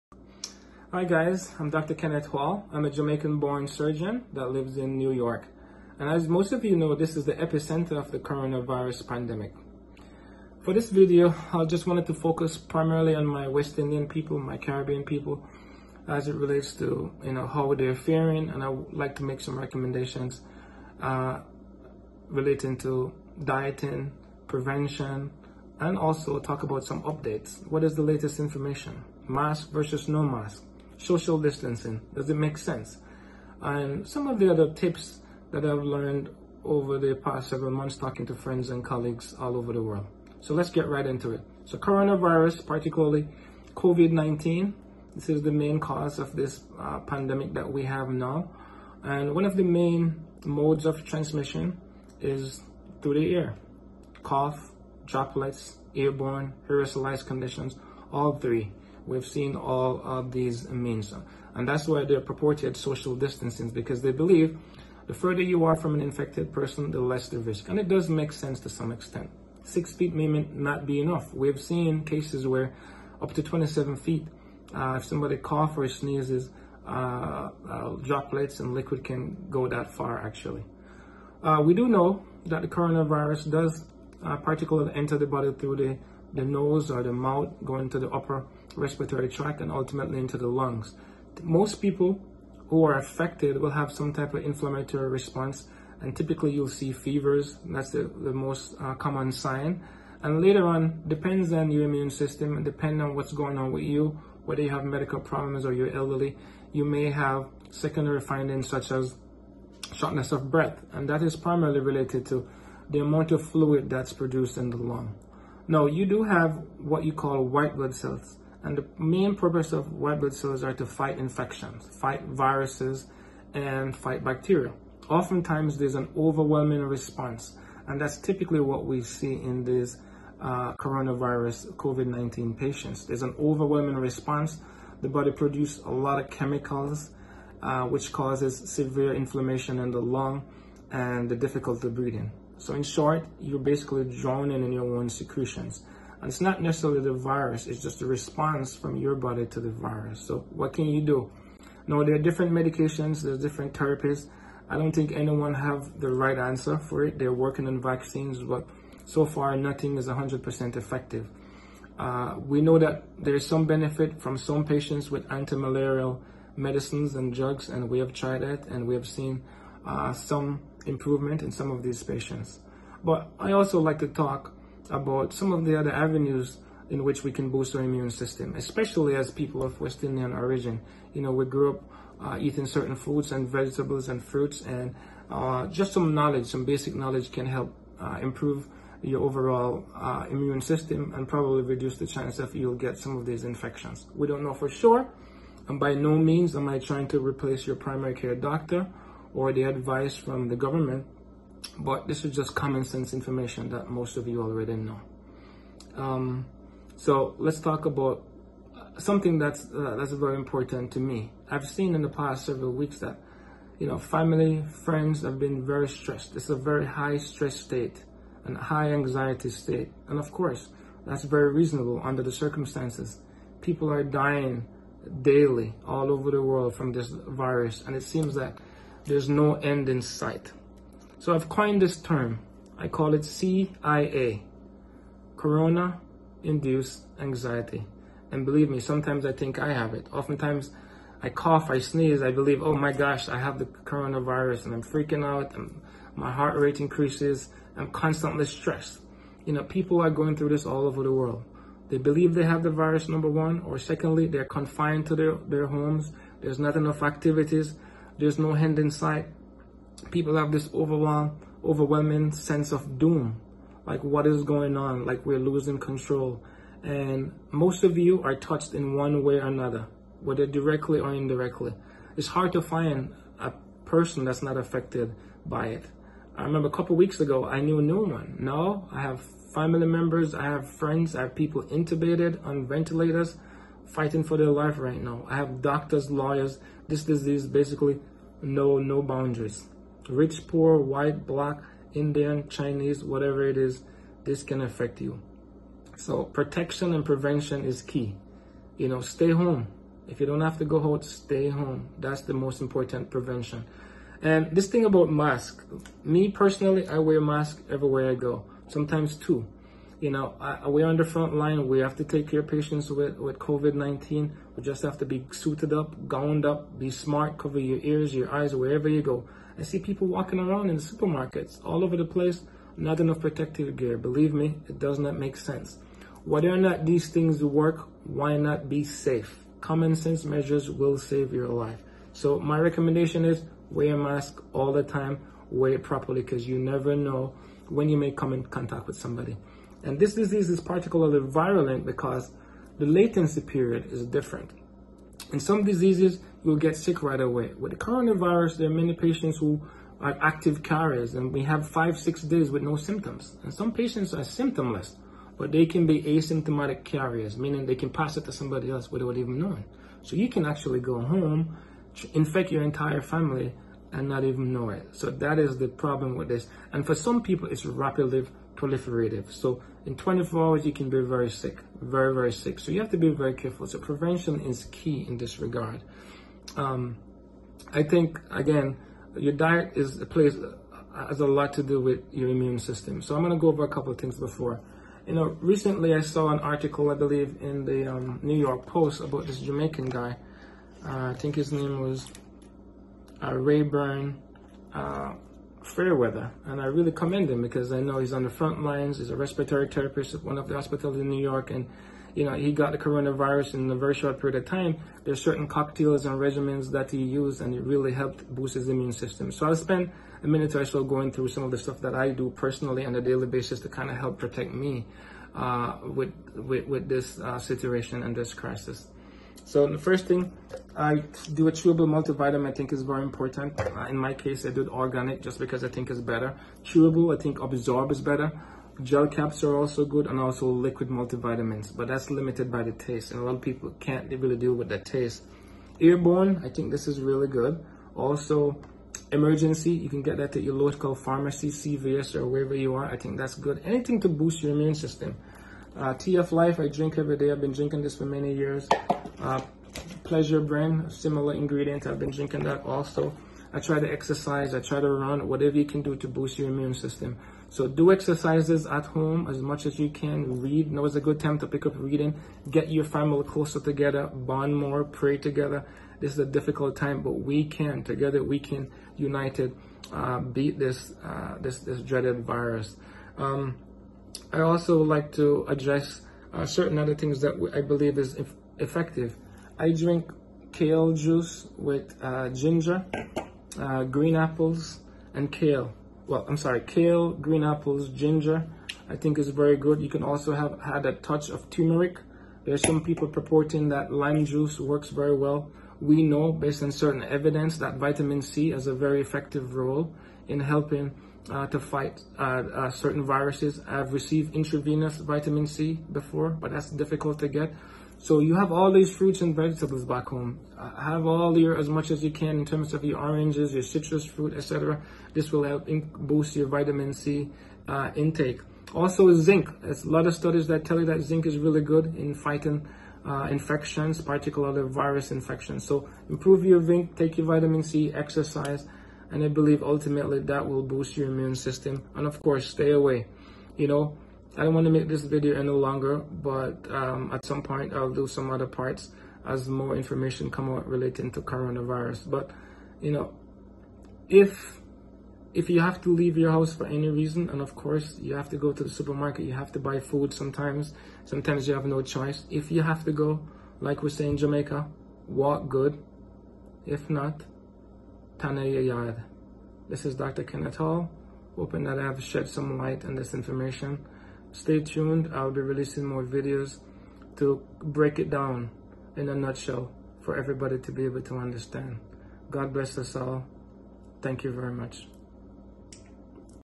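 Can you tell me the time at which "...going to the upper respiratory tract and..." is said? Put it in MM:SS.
01:27.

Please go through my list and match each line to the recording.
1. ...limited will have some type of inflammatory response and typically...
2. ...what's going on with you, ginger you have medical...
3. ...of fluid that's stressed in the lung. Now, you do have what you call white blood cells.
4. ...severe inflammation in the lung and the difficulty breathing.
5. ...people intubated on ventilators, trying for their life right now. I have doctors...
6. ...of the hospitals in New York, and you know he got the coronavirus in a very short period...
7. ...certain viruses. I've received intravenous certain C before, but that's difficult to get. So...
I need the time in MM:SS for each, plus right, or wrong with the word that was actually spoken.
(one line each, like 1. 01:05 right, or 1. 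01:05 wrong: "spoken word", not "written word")
1. 01:32 wrong: "affected", not "limited"
2. 01:43 wrong: "whether", not "ginger"
3. 01:53 wrong: "produced", not "stressed"
4. 02:18 right
5. 04:41 wrong: "fighting", not "trying"
6. 06:40 right
7. 08:22 wrong: "vitamin", not "certain".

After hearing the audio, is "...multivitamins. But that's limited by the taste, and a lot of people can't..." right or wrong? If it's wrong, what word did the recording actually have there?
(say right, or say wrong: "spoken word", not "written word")
right.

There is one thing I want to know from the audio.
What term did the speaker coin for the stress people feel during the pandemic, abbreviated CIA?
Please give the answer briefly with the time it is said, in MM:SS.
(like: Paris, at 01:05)
Corona Induced Anxiety, at 03:55.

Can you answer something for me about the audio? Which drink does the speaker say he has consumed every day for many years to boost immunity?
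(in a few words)
TF Life.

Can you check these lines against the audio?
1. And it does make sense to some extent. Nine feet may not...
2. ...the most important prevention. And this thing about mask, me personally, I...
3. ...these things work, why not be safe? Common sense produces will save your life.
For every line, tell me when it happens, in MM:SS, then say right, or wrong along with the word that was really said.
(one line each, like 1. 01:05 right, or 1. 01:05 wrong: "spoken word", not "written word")
1. 01:07 wrong: "Six", not "Nine"
2. 05:02 right
3. 05:26 wrong: "measures", not "produces".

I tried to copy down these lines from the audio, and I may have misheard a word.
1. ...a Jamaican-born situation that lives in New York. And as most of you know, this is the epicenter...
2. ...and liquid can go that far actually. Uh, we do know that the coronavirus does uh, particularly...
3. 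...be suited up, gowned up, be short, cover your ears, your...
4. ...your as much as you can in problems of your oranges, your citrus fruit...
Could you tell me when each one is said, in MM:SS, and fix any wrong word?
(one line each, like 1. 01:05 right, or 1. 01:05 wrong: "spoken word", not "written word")
1. 00:02 wrong: "surgeon", not "situation"
2. 01:18 right
3. 05:15 wrong: "smart", not "short"
4. 08:31 wrong: "terms", not "problems".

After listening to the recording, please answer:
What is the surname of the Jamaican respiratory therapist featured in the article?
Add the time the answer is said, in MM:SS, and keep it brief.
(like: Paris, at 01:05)
Fairweather, at 06:35.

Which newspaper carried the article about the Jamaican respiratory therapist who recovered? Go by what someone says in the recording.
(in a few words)
New York Post.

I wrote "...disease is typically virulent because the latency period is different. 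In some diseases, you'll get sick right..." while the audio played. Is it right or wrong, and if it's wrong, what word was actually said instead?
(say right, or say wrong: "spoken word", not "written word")
wrong: "particularly", not "typically".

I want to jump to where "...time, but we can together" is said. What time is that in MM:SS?
07:46.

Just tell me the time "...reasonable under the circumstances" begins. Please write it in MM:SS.
03:41.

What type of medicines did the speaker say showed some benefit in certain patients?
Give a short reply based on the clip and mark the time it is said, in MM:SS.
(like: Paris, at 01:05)
Anti-malarial medicines, at 02:45.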